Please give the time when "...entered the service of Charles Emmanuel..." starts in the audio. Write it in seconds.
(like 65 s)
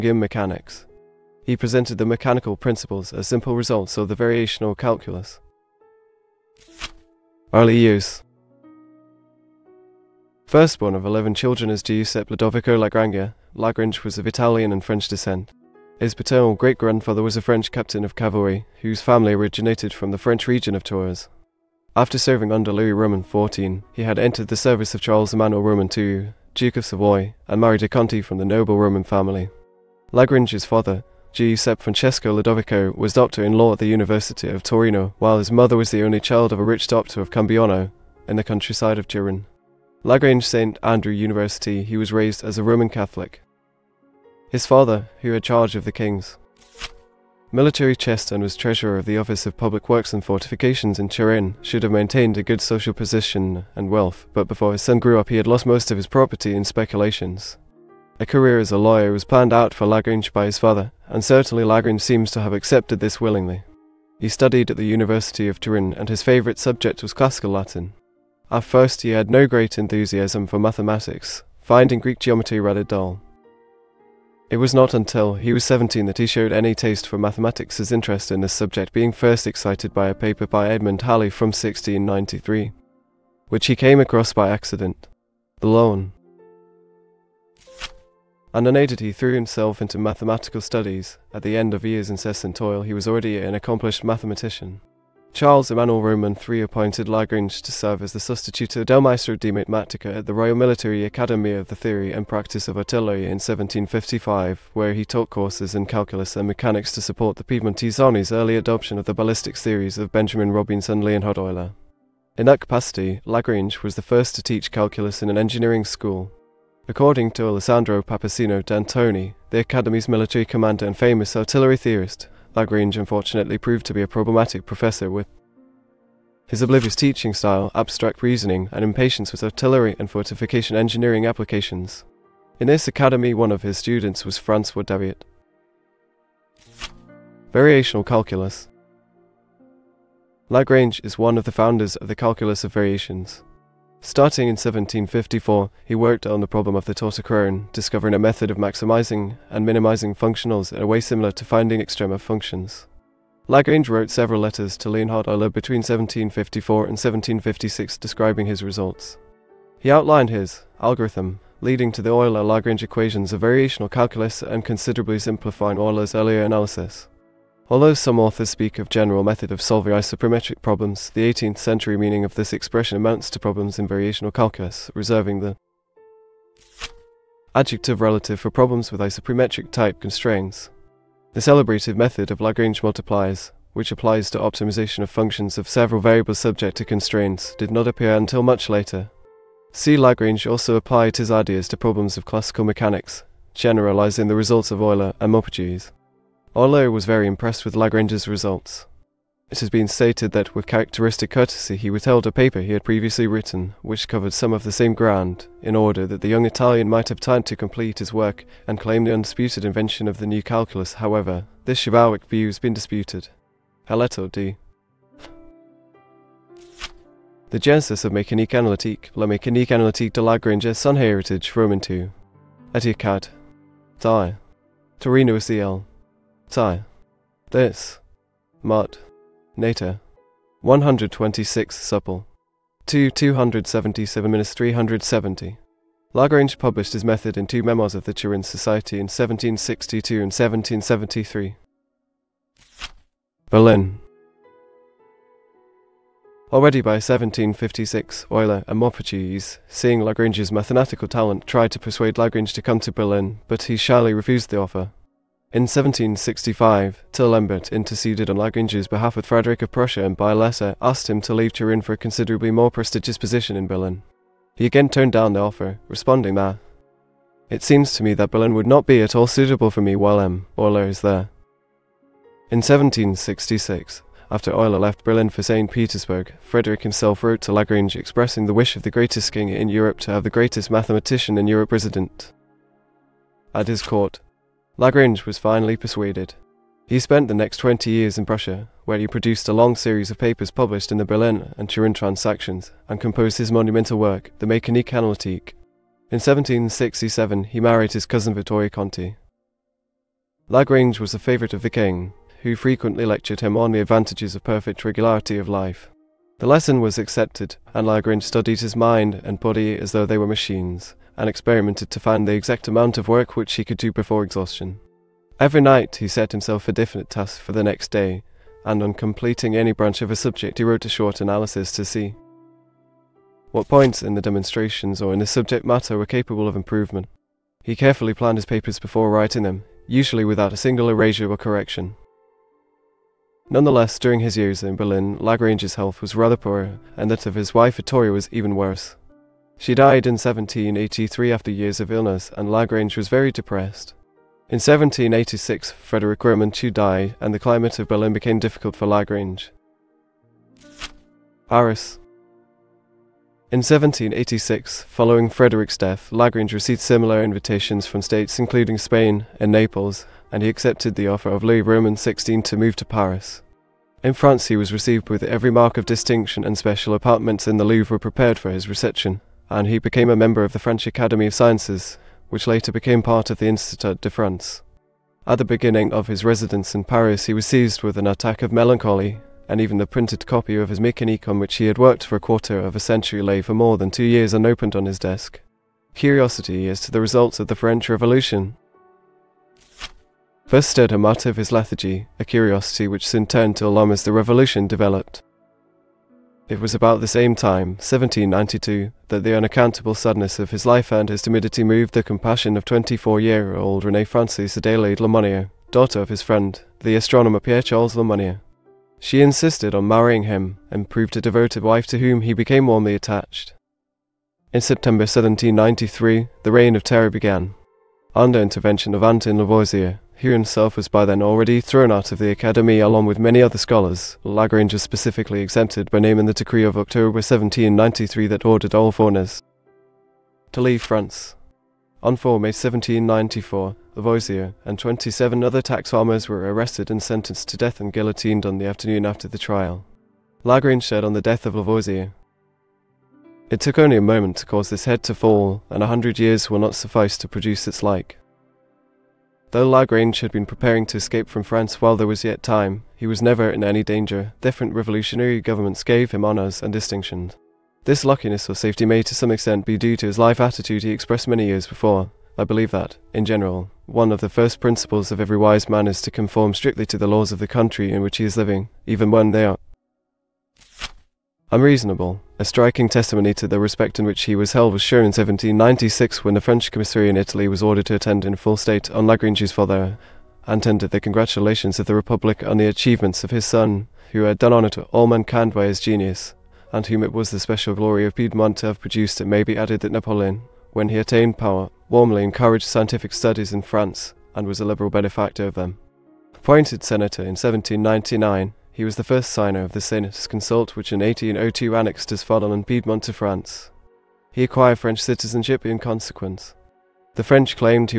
24 s.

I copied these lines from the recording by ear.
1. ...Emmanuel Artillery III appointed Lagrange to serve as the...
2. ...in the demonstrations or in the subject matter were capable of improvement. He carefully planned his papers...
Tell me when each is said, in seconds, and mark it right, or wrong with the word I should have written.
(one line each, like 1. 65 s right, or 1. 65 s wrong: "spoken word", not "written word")
1. 95 s wrong: "Roman", not "Artillery"
2. 324 s right.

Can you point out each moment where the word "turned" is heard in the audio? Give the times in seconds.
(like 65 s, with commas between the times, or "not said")
264 s, 393 s.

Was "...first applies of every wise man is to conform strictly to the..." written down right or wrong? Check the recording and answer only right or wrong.
wrong.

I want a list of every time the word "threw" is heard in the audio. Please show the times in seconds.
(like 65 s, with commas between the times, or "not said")
89 s.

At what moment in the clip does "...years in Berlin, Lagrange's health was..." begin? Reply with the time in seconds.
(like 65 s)
334 s.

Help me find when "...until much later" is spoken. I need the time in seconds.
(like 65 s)
188 s.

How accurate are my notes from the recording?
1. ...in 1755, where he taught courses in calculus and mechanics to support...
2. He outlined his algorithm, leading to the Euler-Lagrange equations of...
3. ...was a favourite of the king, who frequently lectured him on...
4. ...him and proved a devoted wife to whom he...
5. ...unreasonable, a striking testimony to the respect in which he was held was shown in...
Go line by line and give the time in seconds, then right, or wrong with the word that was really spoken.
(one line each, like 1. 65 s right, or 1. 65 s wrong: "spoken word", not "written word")
1. 103 s right
2. 159 s right
3. 300 s right
4. 410 s right
5. 471 s right.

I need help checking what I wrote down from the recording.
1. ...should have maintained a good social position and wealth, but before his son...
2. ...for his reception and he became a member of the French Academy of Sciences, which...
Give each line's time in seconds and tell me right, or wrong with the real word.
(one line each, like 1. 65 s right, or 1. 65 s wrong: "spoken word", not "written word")
1. 51 s right
2. 368 s right.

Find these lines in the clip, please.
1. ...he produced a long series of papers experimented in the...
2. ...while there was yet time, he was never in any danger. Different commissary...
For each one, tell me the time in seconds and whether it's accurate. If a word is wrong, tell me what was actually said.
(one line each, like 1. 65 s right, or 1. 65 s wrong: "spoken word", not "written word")
1. 288 s wrong: "published", not "experimented"
2. 451 s wrong: "revolutionary", not "commissary".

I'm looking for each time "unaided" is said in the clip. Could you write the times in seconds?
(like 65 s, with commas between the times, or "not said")
88 s.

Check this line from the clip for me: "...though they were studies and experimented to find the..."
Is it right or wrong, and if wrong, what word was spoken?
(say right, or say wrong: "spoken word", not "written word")
wrong: "machines", not "studies".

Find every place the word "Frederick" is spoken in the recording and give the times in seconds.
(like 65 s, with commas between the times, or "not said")
259 s, 276 s, 345 s, 355 s.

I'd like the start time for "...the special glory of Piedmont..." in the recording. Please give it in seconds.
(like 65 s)
487 s.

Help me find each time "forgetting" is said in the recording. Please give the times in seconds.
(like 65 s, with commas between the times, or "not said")
not said.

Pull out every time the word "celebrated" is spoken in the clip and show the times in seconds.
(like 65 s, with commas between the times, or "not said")
181 s.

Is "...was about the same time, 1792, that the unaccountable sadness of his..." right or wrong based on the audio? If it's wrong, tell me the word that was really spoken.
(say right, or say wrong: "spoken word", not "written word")
right.